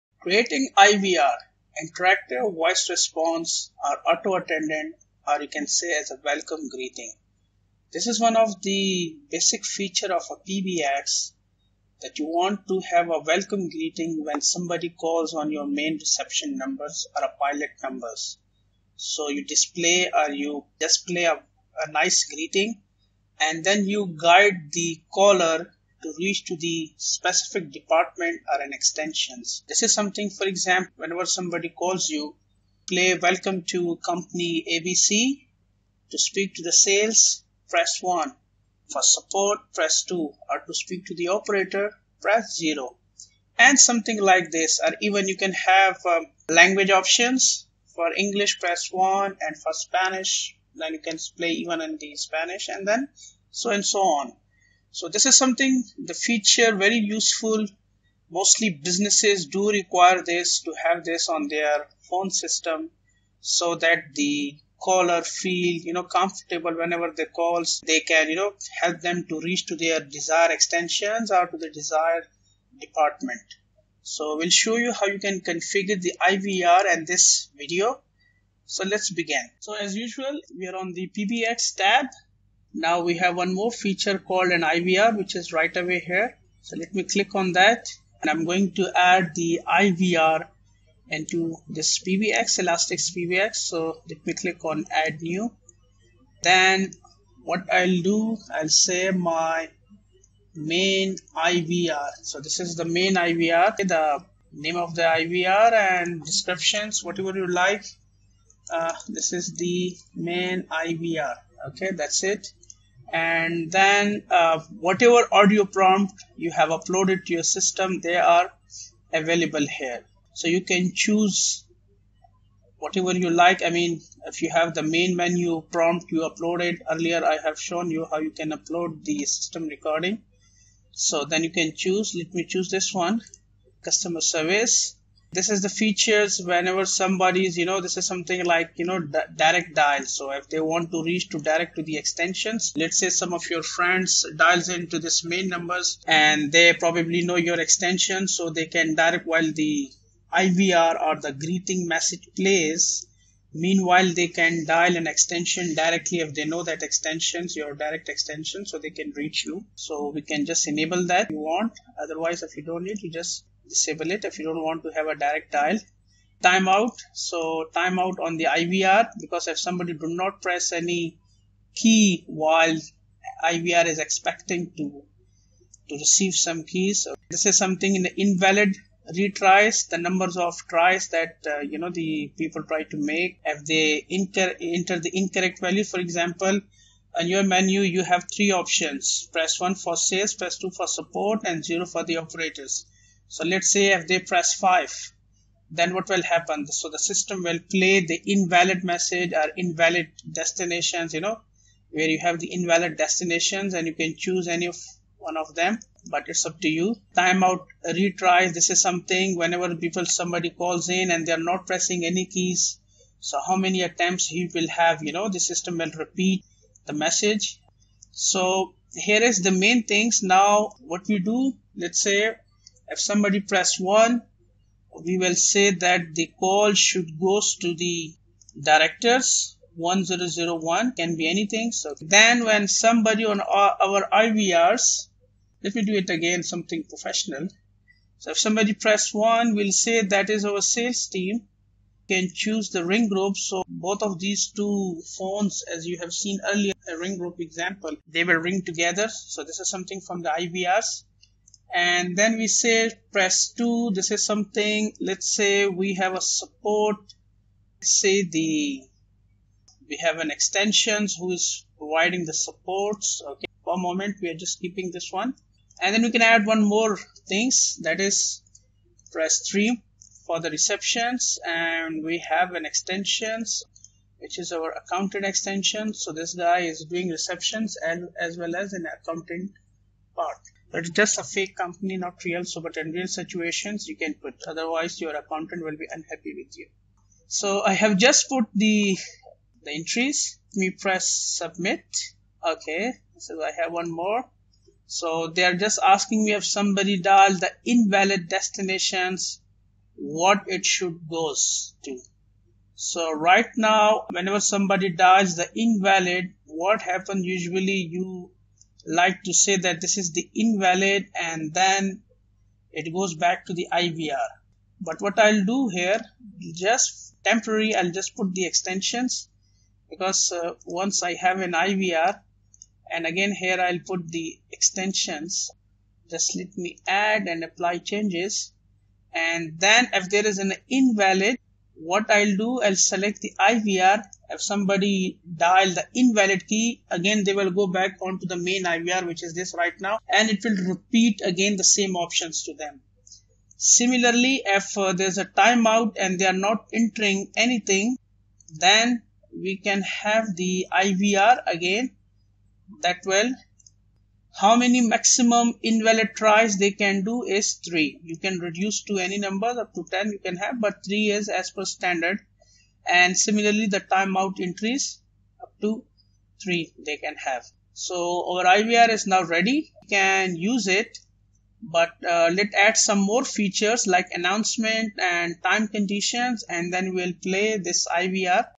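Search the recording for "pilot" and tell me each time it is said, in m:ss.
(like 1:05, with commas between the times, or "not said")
0:17.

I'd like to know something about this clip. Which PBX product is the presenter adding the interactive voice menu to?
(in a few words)
Elastix PBX.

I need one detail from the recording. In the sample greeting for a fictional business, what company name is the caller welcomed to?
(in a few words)
company ABC.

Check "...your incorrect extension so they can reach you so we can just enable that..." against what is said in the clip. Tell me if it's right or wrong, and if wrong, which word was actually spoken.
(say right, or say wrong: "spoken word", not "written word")
wrong: "direct", not "incorrect".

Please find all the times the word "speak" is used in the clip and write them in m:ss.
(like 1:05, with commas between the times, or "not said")
0:36, 0:40.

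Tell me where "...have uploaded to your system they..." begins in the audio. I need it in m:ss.
1:56.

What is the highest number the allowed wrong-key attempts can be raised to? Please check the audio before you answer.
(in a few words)
10.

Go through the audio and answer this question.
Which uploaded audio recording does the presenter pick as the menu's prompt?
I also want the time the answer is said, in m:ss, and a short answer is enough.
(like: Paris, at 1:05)
customer service, at 2:13.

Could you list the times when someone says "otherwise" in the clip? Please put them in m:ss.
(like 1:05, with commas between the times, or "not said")
2:42, 4:44.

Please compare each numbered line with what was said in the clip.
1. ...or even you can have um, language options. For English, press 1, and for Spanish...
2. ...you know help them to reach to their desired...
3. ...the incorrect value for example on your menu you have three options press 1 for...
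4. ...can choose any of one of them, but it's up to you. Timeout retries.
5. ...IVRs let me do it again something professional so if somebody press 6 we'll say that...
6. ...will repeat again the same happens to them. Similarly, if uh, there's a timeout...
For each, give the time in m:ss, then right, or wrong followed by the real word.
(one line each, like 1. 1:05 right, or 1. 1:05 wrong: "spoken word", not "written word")
1. 0:44 right
2. 1:08 right
3. 3:05 right
4. 3:23 right
5. 3:54 wrong: "1", not "6"
6. 5:40 wrong: "options", not "happens".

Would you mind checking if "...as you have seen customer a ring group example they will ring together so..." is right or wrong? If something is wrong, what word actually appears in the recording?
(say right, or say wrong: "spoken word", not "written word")
wrong: "earlier", not "customer".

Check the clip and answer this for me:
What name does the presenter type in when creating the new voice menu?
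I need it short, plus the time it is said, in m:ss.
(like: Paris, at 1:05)
my main IVR, at 1:39.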